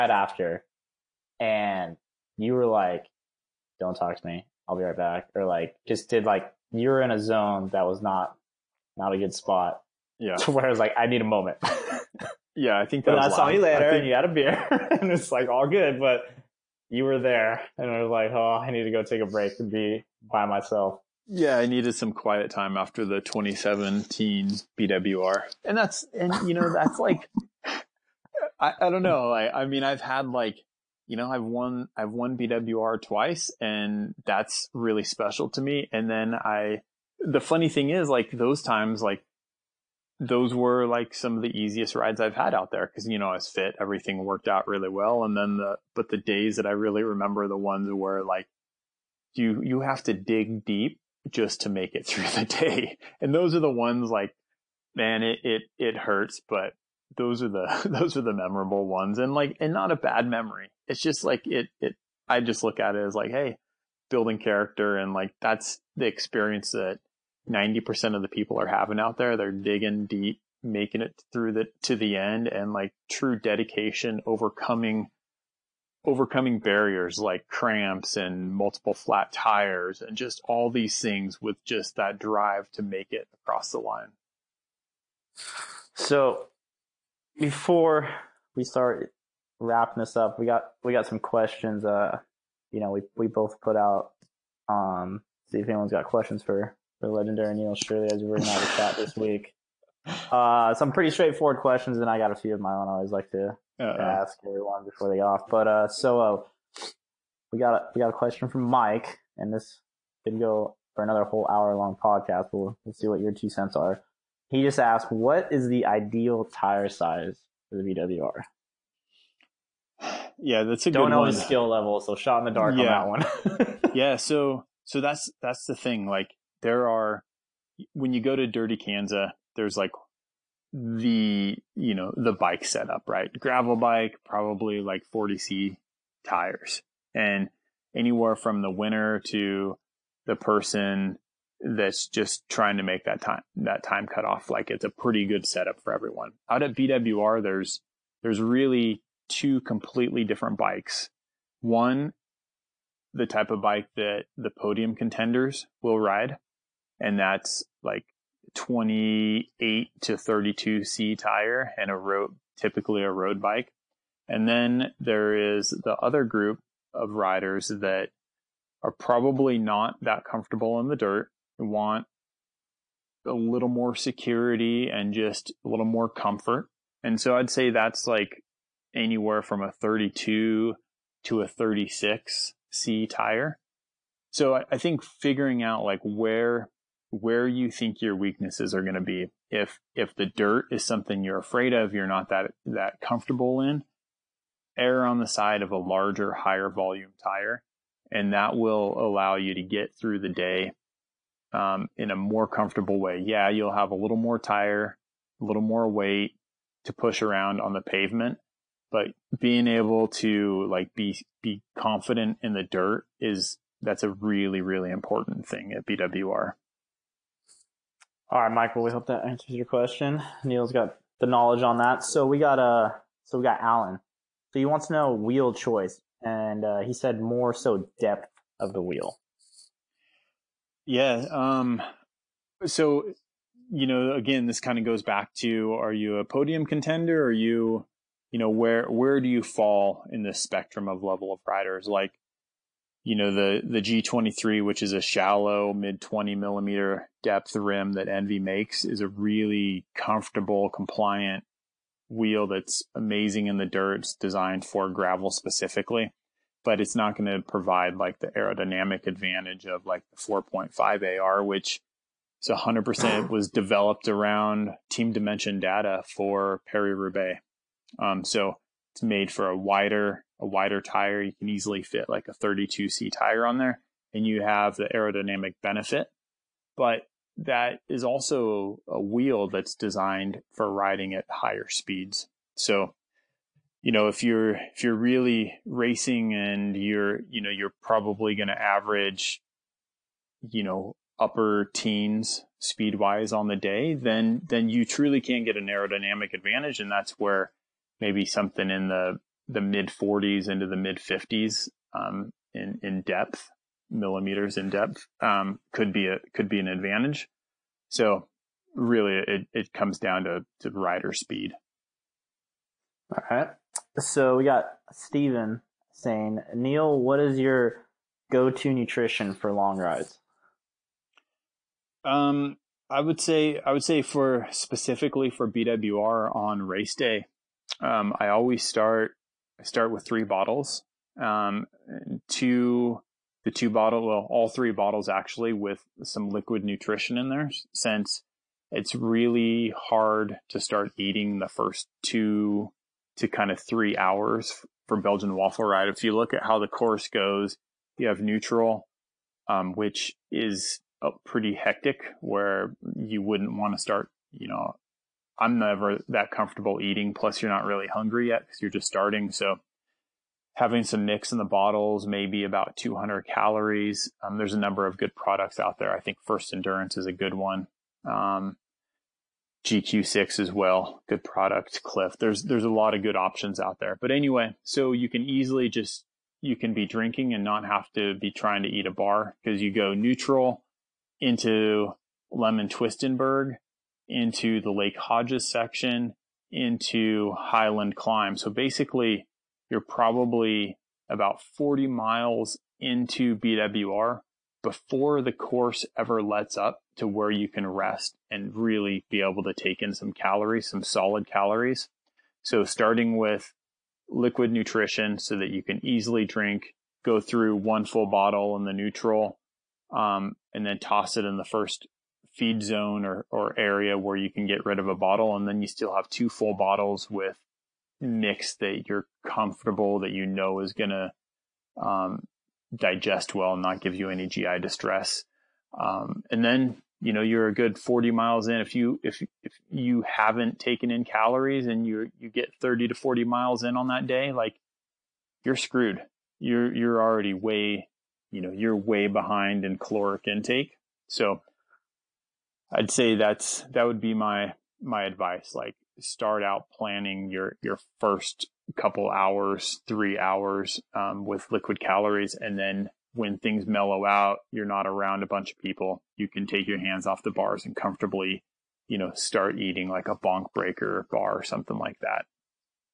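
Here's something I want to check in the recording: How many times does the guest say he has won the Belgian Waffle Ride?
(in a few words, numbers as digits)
2.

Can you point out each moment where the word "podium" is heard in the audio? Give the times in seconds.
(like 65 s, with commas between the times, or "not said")
154 s, 236 s.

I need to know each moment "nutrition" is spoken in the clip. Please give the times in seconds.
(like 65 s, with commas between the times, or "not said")
318 s, 336 s, 404 s.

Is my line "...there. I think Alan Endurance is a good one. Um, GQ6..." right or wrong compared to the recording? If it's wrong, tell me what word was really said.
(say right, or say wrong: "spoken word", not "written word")
wrong: "First", not "Alan".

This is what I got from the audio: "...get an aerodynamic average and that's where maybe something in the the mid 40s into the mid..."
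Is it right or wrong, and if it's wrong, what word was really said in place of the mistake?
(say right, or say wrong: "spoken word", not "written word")
wrong: "advantage", not "average".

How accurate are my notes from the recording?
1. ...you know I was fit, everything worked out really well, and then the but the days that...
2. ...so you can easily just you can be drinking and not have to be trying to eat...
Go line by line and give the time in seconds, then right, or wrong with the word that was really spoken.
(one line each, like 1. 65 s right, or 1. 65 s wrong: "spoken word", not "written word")
1. 43 s right
2. 374 s right.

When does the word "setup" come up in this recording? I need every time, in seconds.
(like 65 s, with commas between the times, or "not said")
132 s, 145 s.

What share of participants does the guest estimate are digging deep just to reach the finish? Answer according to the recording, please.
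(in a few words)
90%.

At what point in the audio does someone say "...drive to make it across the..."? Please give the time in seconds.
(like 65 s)
82 s.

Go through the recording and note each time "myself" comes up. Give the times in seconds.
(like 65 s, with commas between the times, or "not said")
20 s.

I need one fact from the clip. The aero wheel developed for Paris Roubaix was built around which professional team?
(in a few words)
Team Dimension Data.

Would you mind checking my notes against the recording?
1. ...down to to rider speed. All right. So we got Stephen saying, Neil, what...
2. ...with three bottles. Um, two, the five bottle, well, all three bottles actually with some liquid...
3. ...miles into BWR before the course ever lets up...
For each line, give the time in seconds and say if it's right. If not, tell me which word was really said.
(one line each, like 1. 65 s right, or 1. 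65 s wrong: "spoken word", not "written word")
1. 309 s right
2. 329 s wrong: "two", not "five"
3. 391 s right.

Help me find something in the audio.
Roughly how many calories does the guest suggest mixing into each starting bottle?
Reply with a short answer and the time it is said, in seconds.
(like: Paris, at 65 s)
200, at 362 s.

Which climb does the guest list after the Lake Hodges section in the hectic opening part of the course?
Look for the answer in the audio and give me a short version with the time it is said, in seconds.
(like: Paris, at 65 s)
Highland Climb, at 387 s.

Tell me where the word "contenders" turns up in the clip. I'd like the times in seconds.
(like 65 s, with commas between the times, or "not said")
154 s, 236 s.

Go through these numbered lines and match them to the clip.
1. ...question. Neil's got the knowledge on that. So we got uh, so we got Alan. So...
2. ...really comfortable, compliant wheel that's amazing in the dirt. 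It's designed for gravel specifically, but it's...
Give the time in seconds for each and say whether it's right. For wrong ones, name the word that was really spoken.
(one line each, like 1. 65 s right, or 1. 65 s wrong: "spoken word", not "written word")
1. 219 s right
2. 249 s right.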